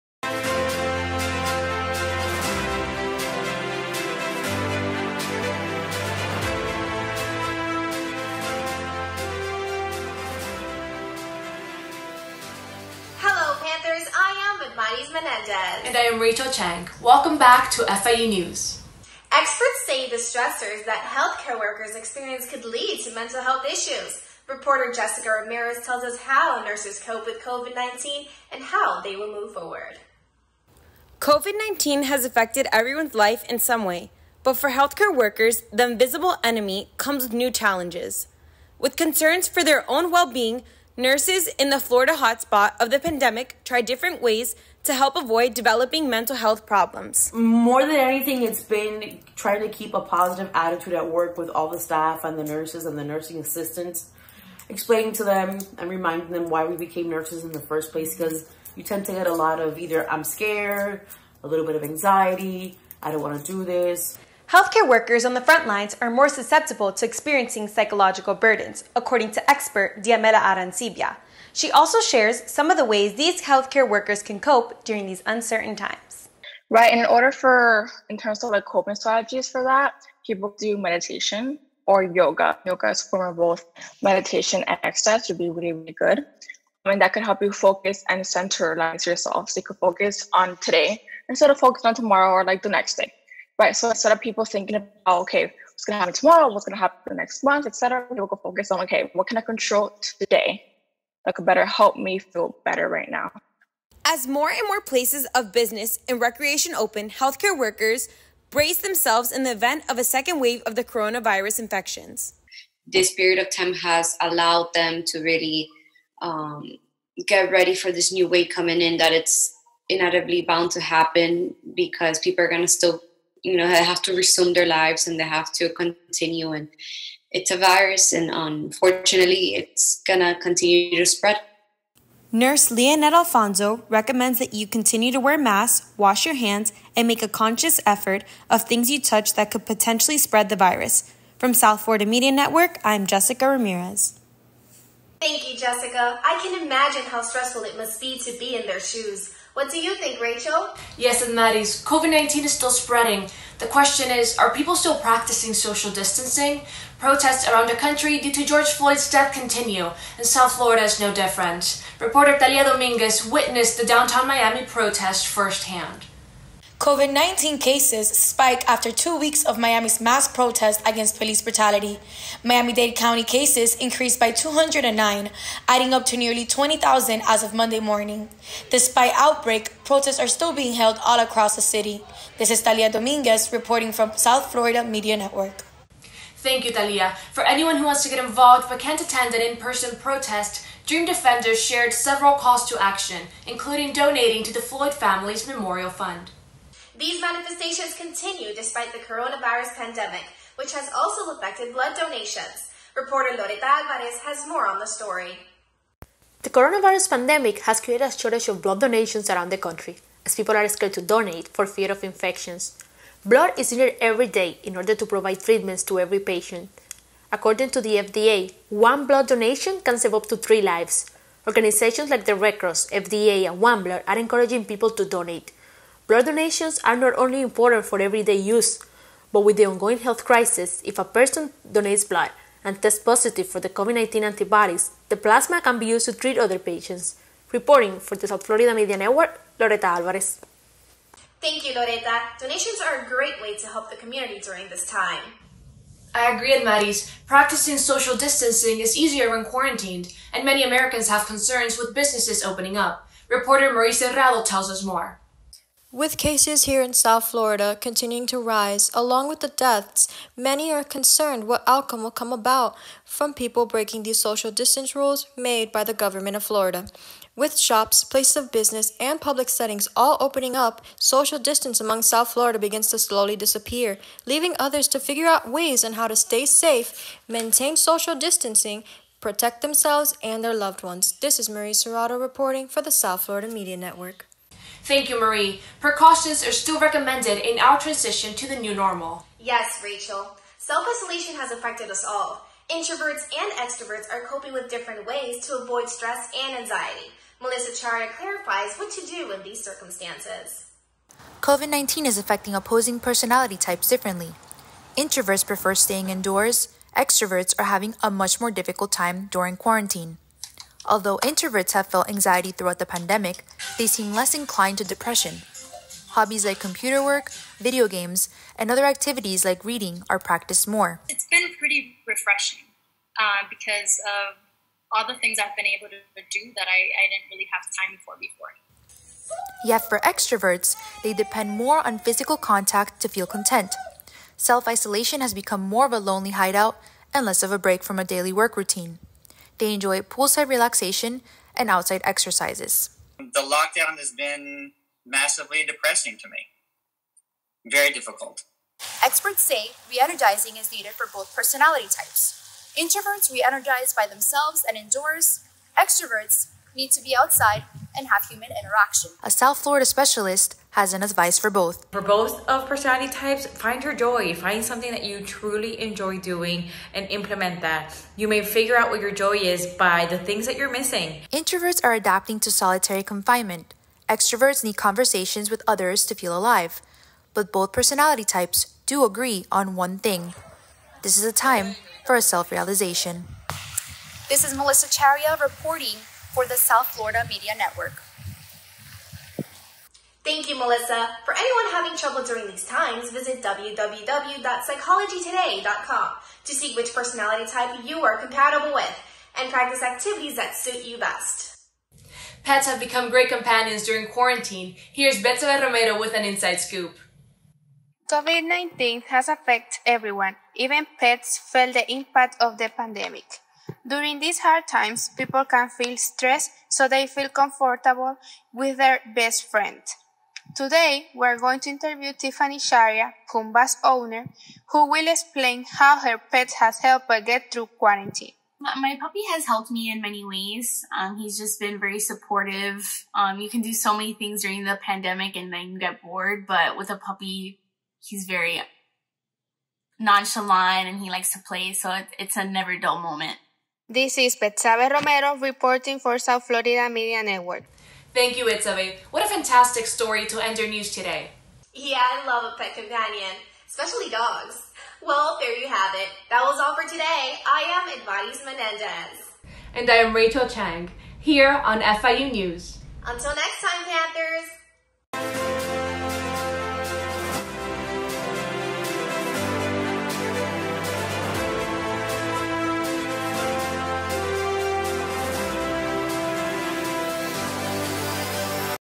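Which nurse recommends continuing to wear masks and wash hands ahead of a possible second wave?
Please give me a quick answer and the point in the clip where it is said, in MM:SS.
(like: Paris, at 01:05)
Leonette Alfonso, at 02:12.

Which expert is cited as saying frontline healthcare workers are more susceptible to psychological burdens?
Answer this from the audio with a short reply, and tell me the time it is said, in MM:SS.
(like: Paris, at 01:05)
Diamela Arancibia, at 01:10.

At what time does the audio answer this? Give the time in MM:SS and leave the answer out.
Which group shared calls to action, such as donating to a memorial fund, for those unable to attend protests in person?
03:10.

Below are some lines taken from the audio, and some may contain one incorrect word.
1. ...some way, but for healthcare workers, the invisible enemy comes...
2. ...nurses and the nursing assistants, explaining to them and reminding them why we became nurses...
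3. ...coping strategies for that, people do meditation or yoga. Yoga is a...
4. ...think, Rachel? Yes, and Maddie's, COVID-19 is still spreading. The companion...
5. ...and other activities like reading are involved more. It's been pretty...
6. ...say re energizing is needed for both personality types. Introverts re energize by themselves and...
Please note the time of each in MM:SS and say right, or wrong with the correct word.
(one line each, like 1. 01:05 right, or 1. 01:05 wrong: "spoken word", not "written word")
1. 00:33 right
2. 00:52 right
3. 01:18 right
4. 02:29 wrong: "question", not "companion"
5. 05:18 wrong: "practiced", not "involved"
6. 05:49 right.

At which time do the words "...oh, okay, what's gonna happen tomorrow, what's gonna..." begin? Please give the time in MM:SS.
01:35.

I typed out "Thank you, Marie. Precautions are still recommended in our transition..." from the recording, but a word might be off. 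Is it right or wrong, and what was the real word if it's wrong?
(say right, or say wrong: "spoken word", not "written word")
right.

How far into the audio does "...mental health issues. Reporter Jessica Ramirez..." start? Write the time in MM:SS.
00:23.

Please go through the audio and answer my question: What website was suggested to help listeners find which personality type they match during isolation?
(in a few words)
www.psychologytoday.com.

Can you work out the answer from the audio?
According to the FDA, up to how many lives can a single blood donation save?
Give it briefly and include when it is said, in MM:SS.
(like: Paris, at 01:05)
3, at 03:40.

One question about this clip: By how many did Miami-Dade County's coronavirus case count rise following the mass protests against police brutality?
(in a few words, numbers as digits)
209.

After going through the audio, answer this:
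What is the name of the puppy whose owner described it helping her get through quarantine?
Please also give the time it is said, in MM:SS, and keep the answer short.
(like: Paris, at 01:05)
Pumba, at 07:03.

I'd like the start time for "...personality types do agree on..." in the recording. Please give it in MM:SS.
06:17.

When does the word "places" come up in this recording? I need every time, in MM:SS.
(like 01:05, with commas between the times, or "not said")
00:57, 01:44, 04:28.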